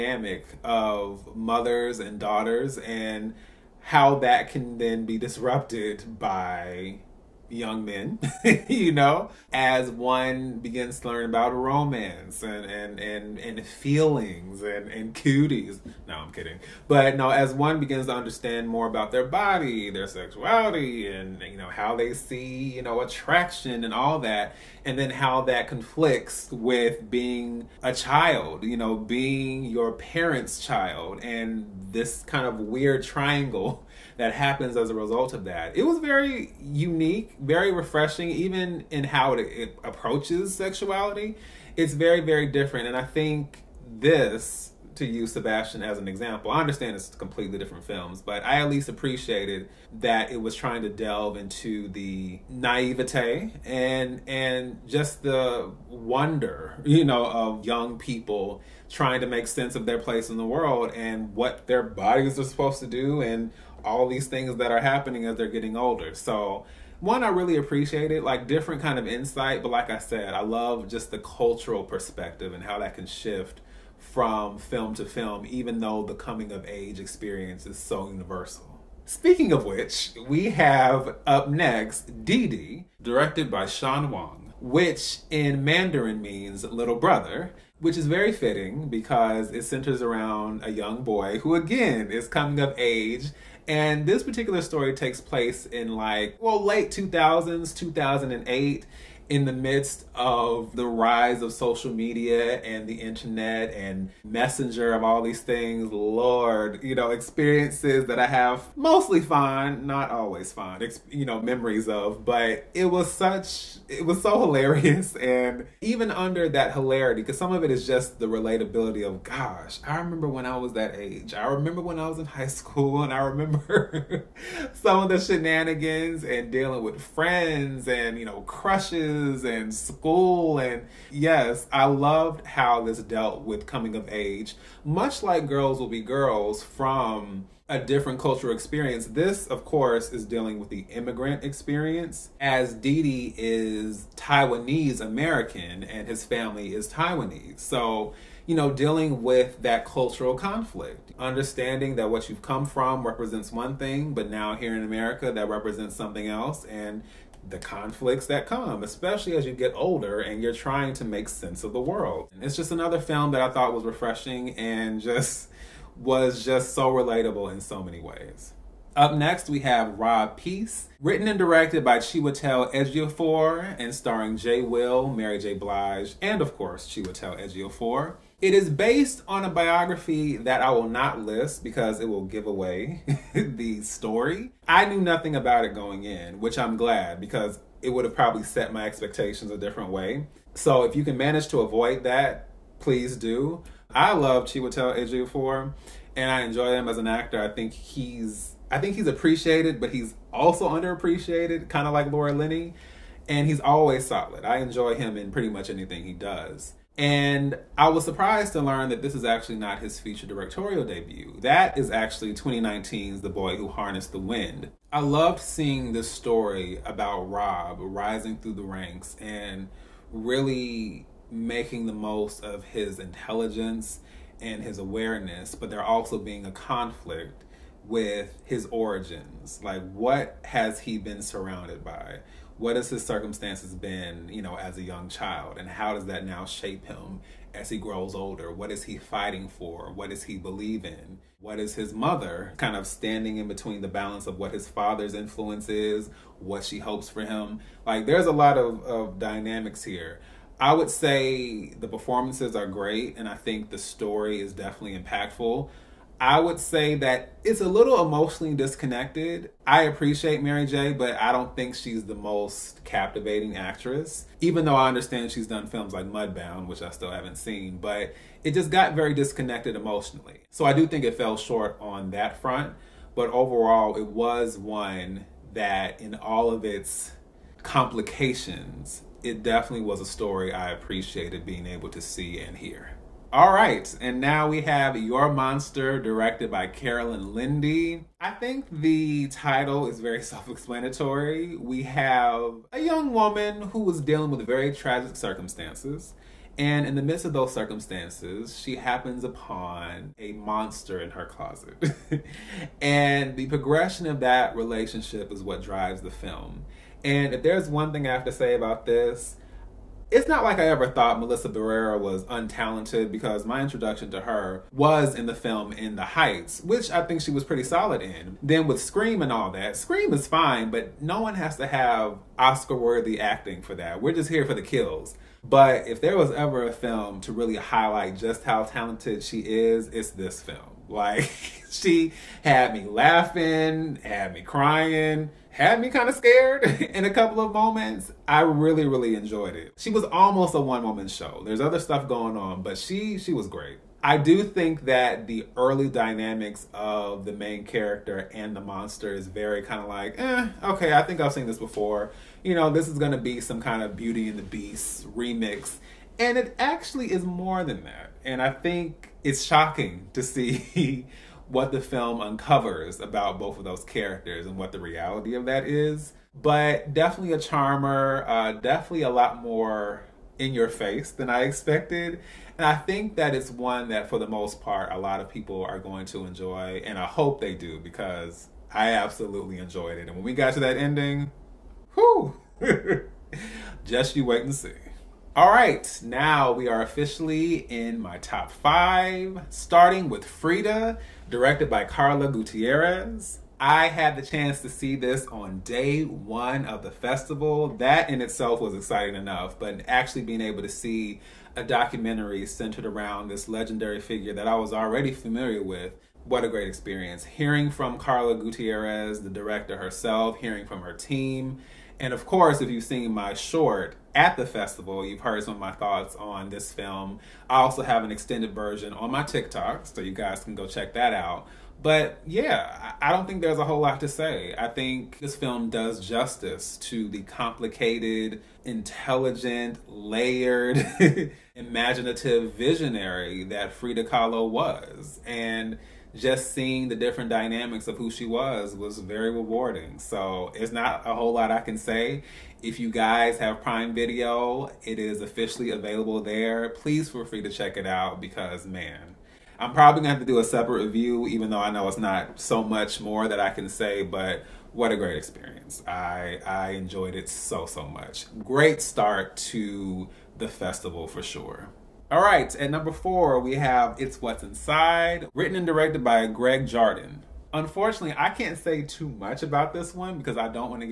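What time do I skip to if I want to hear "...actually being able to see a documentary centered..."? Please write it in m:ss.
6:39.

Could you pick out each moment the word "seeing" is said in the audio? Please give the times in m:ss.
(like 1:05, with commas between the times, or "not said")
3:35, 7:16.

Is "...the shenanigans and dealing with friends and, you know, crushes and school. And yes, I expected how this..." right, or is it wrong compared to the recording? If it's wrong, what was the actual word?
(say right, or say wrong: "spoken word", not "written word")
wrong: "loved", not "expected".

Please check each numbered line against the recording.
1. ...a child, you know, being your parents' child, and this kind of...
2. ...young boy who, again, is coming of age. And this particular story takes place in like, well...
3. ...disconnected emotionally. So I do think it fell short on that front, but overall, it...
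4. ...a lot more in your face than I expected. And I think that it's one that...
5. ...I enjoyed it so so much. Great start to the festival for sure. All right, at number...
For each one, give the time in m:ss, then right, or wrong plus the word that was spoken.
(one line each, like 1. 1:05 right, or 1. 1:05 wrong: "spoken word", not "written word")
1. 0:27 right
2. 1:30 right
3. 4:29 right
4. 6:09 right
5. 7:36 right.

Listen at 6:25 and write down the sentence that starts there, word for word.
All right, now we are officially in my top five, starting with Frida, directed by Carla Gutierrez.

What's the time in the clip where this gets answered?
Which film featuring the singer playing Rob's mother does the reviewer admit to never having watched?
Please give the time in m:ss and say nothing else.
4:26.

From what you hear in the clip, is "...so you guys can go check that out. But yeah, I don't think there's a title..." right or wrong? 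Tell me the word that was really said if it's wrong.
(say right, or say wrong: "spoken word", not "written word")
wrong: "whole", not "title".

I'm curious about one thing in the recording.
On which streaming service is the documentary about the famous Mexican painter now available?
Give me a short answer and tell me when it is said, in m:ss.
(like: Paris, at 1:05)
Prime Video, at 7:23.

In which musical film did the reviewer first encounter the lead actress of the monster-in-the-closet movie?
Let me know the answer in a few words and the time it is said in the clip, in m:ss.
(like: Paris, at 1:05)
In the Heights, at 5:15.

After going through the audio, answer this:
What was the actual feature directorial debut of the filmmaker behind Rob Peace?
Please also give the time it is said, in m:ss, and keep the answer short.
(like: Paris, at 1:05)
The Boy Who Harnessed the Wind, at 3:33.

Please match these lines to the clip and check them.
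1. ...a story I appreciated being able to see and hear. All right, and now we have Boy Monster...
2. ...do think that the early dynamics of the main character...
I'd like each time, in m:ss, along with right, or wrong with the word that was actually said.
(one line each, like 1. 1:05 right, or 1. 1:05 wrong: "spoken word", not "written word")
1. 4:39 wrong: "Your", not "Boy"
2. 5:44 right.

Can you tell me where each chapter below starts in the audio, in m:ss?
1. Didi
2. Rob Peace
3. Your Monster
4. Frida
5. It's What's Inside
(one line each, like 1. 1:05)
1. 1:19
2. 2:48
3. 4:43
4. 6:25
5. 7:41.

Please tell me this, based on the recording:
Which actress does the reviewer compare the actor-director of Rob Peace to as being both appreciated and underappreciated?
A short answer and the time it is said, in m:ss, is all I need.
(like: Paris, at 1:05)
Laura Linney, at 3:22.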